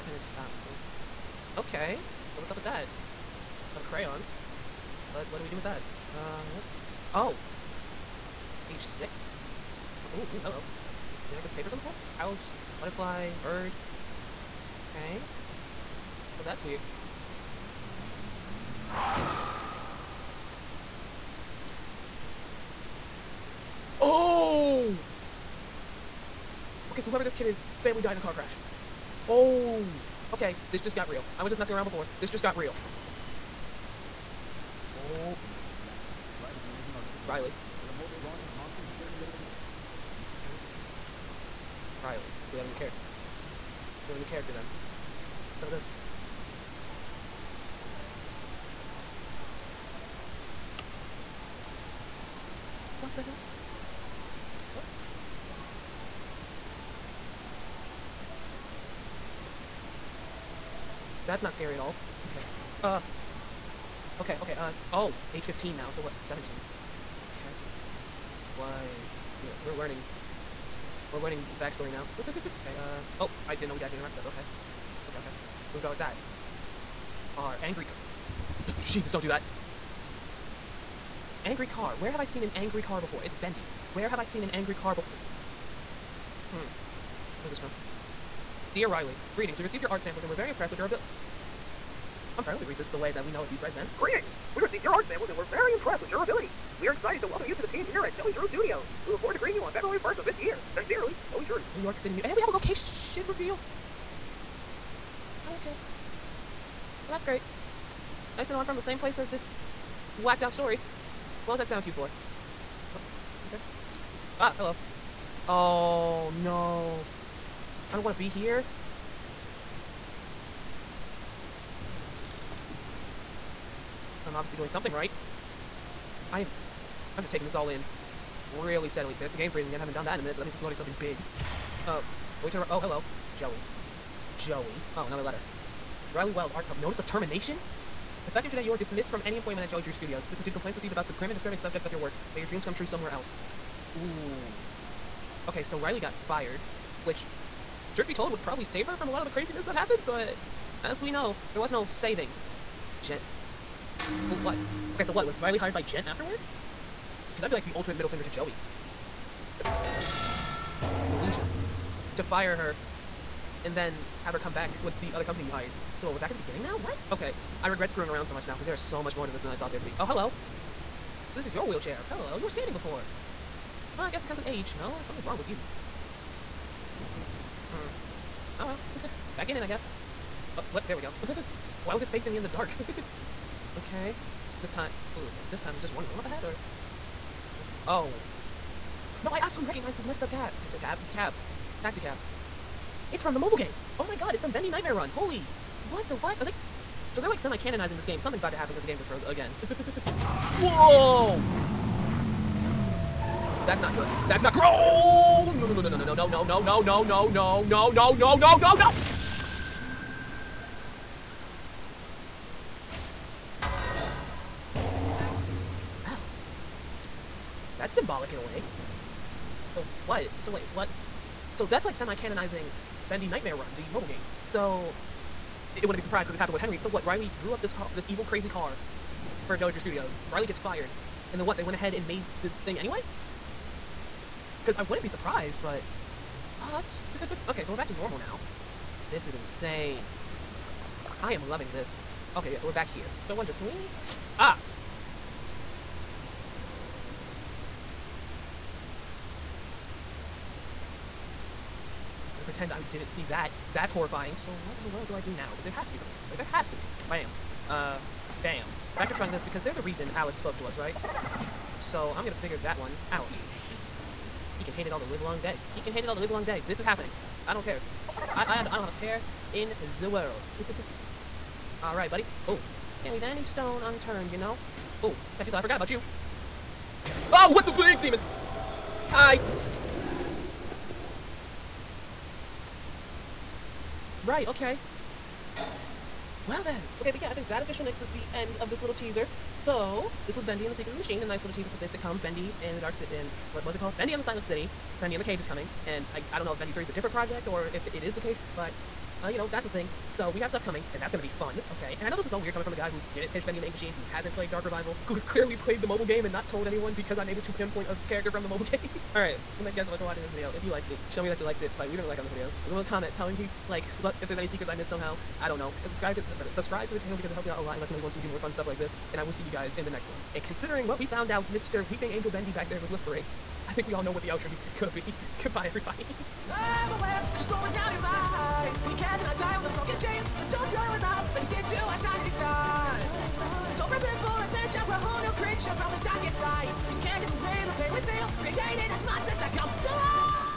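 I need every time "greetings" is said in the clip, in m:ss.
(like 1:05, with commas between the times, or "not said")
1:29, 1:33, 1:39.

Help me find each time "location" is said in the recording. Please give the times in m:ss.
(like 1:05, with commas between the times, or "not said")
1:42.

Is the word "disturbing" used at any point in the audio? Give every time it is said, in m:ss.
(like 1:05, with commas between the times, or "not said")
2:21.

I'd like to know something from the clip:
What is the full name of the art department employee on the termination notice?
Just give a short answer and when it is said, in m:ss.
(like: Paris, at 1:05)
Riley Wells, at 2:16.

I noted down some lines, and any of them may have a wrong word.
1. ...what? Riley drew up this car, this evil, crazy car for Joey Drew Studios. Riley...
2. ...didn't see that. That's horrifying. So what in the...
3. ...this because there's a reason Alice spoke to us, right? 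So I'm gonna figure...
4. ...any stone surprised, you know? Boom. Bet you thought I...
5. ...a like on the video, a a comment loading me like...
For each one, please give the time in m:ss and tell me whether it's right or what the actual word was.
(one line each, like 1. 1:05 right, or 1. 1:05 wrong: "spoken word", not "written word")
1. 3:46 right
2. 4:12 right
3. 4:19 right
4. 4:33 wrong: "unturned", not "surprised"
5. 5:12 wrong: "telling", not "loading".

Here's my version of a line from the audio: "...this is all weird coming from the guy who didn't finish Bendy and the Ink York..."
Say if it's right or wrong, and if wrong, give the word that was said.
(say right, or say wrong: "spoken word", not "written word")
wrong: "Machine", not "York".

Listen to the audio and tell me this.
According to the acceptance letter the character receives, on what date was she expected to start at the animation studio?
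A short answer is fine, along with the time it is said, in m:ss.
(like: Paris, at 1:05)
February 1st, at 1:39.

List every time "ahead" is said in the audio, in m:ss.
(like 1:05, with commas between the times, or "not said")
3:06, 3:51.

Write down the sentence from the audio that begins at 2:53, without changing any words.
Well, I guess it comes with age.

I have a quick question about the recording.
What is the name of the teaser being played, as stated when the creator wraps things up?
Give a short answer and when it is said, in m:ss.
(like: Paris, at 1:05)
Bendy and the Secrets of the Machine, at 4:50.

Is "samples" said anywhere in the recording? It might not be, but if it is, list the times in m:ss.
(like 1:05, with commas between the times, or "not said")
1:30, 1:35.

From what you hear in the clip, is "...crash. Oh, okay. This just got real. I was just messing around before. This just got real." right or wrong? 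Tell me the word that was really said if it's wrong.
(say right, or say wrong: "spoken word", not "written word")
right.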